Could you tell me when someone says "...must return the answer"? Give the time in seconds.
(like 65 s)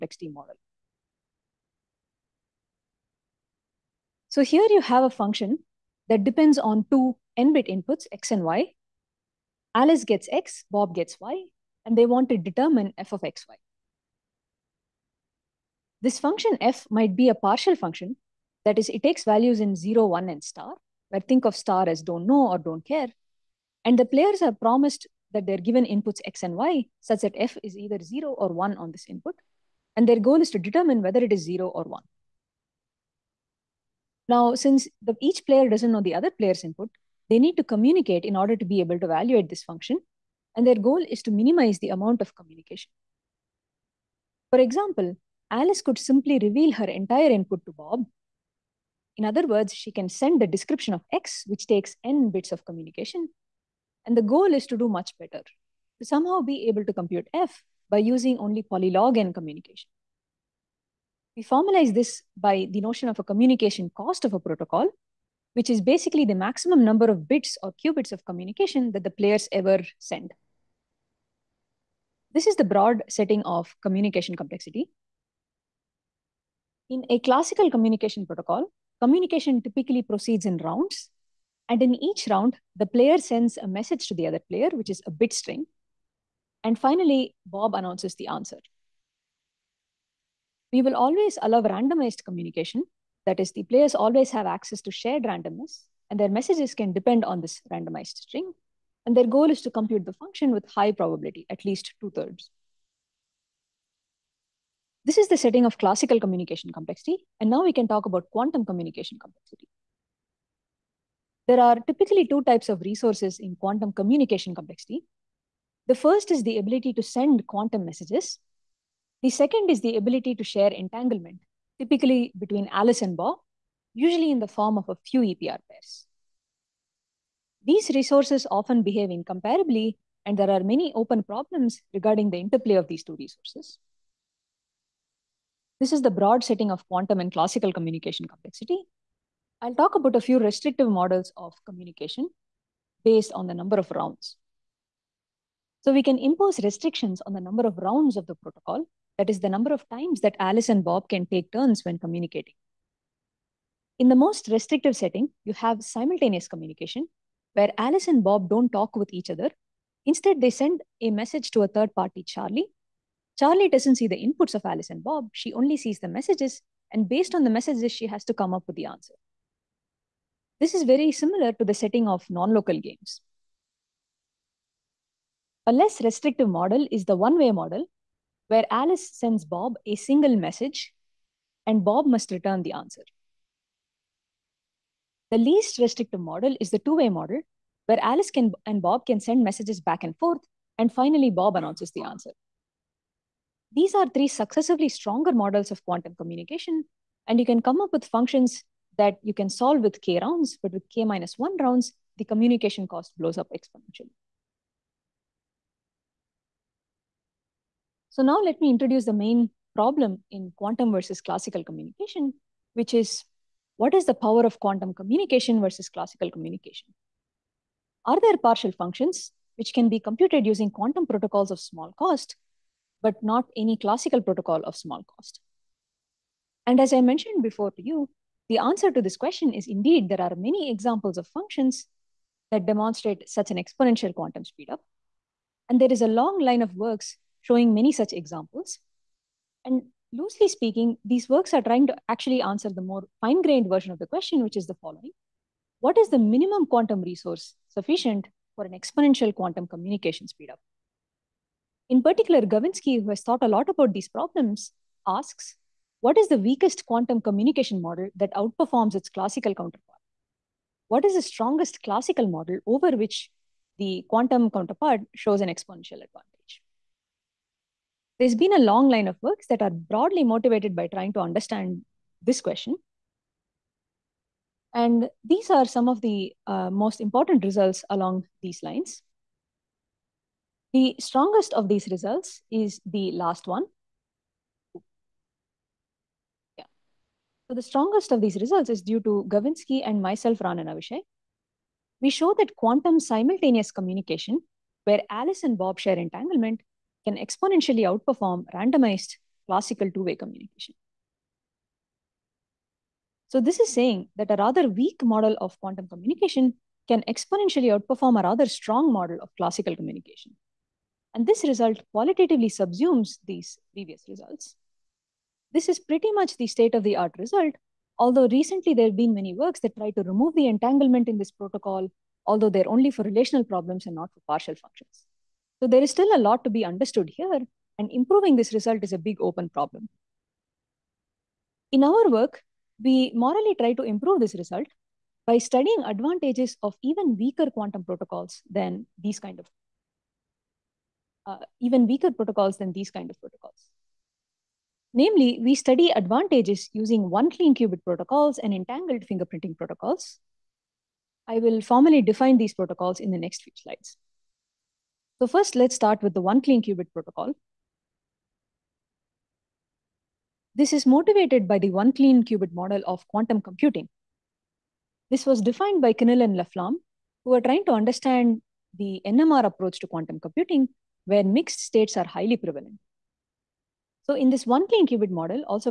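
182 s.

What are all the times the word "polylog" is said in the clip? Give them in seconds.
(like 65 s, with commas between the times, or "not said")
58 s.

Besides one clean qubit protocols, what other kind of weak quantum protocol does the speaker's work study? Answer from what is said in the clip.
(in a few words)
entangled fingerprinting protocols.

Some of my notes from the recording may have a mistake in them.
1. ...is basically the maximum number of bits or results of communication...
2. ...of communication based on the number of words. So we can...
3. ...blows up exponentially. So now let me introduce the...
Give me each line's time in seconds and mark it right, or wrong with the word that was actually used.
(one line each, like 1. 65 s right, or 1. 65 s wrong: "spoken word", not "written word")
1. 65 s wrong: "qubits", not "results"
2. 141 s wrong: "rounds", not "words"
3. 203 s right.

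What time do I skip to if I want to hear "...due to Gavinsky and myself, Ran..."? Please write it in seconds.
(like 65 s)
288 s.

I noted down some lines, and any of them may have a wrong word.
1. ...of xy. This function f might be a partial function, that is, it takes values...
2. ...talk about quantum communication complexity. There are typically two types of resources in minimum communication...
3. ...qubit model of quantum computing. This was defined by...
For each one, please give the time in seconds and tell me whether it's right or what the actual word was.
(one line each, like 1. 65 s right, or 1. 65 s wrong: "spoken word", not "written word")
1. 13 s right
2. 107 s wrong: "quantum", not "minimum"
3. 362 s right.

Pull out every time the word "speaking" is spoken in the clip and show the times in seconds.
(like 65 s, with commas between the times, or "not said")
240 s.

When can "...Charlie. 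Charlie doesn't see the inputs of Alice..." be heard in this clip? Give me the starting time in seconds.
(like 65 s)
162 s.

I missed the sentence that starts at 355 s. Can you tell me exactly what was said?
So first, let's start with the one clean qubit protocol.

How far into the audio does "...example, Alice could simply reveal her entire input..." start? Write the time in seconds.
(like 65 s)
44 s.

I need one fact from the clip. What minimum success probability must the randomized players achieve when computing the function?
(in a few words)
two-thirds.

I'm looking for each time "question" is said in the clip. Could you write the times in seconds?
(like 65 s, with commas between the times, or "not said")
229 s, 244 s, 272 s.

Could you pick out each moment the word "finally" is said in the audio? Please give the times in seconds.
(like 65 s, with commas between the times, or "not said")
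86 s, 190 s.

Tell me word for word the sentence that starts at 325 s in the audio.
So there is still a lot to be understood here, and improving this result is a big open problem.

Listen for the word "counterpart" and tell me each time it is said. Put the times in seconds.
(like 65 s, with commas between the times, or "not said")
259 s, 264 s.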